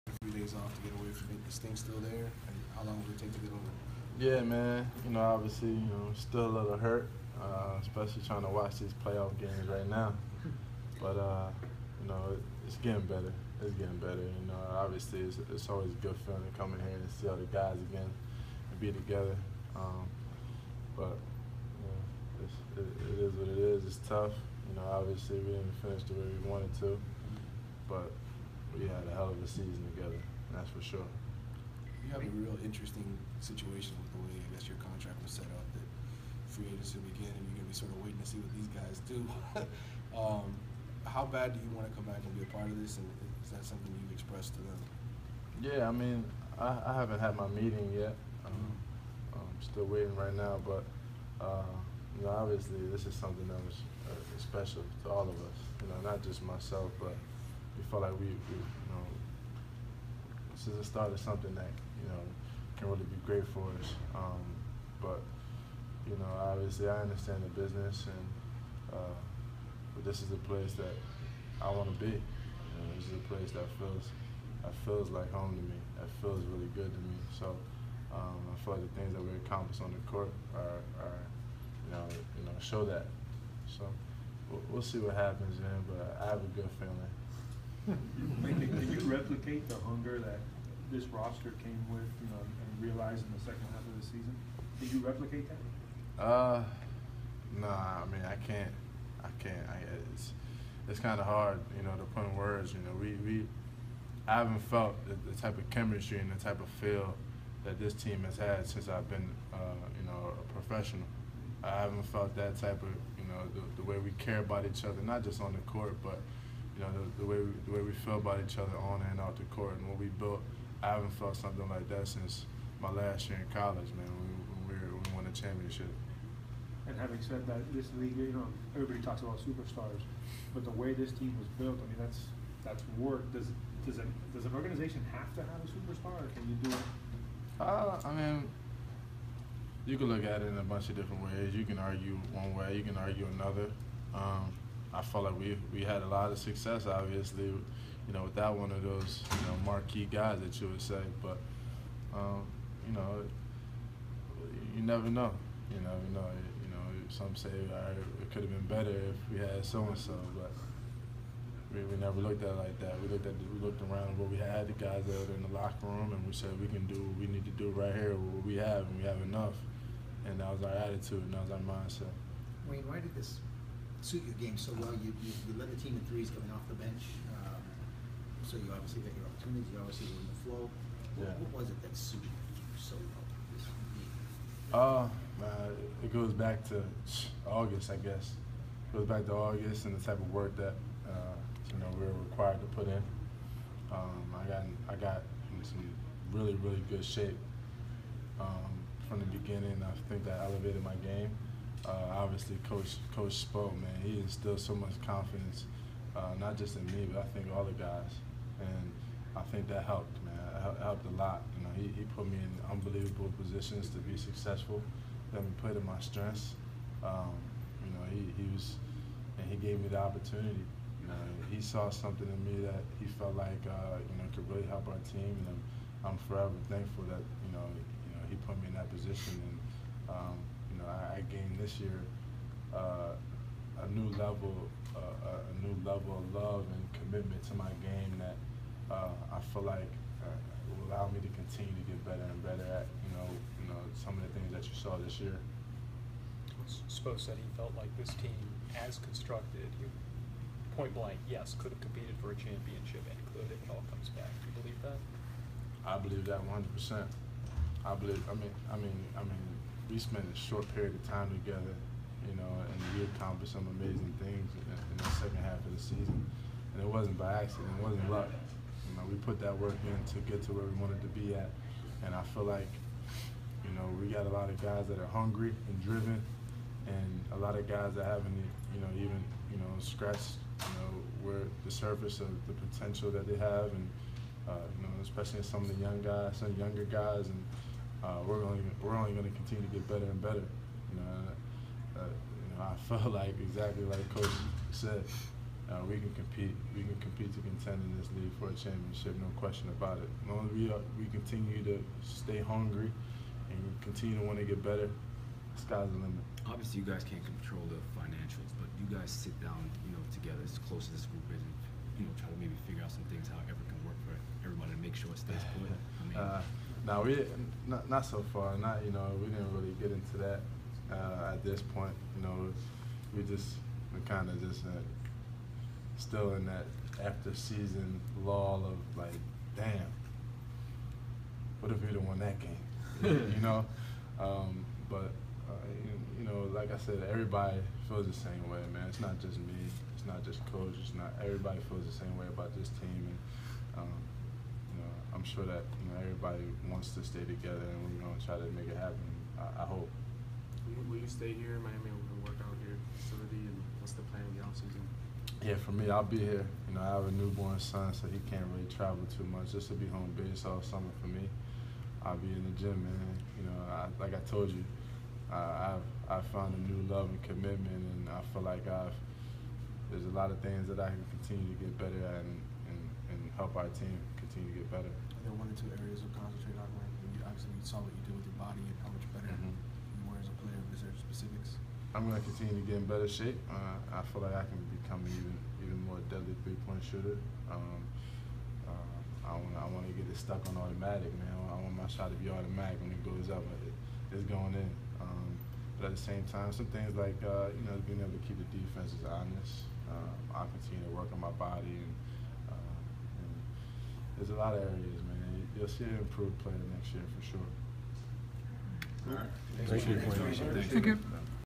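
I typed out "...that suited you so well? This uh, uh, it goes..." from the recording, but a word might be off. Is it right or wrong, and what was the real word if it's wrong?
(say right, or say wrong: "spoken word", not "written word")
right.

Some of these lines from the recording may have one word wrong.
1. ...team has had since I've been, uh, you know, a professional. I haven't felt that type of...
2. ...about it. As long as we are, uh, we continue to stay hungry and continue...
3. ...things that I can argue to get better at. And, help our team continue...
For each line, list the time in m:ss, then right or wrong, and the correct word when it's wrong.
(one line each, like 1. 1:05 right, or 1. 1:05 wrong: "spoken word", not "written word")
1. 1:47 right
2. 4:59 right
3. 6:10 wrong: "continue", not "argue".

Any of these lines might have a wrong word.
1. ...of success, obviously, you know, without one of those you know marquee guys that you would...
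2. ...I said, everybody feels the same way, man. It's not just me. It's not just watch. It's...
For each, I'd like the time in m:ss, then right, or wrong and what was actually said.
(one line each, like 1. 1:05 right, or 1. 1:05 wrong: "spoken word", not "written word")
1. 2:26 right
2. 5:36 wrong: "coach", not "watch".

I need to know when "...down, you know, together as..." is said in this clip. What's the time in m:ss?
5:09.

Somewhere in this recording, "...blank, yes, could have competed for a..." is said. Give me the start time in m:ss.
4:10.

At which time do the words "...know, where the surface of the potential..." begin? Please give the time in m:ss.
4:40.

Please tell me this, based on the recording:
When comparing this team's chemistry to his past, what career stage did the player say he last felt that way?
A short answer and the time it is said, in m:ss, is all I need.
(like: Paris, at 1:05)
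Last year in college, at 2:02.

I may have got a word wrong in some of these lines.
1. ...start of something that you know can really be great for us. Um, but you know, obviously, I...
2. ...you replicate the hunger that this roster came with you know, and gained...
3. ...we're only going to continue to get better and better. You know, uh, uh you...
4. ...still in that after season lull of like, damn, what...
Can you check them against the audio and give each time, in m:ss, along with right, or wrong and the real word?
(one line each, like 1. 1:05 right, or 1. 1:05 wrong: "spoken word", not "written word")
1. 1:00 right
2. 1:28 wrong: "realized", not "gained"
3. 4:48 right
4. 5:25 right.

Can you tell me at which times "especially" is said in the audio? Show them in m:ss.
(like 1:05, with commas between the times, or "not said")
0:07, 4:45.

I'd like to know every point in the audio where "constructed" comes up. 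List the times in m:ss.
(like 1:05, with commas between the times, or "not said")
4:08.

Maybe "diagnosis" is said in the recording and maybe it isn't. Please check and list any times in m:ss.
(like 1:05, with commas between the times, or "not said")
not said.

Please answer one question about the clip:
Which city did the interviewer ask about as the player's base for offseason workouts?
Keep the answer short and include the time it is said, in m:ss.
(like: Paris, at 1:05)
Miami, at 5:51.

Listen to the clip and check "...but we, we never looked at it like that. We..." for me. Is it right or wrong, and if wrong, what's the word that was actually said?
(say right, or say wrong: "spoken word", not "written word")
right.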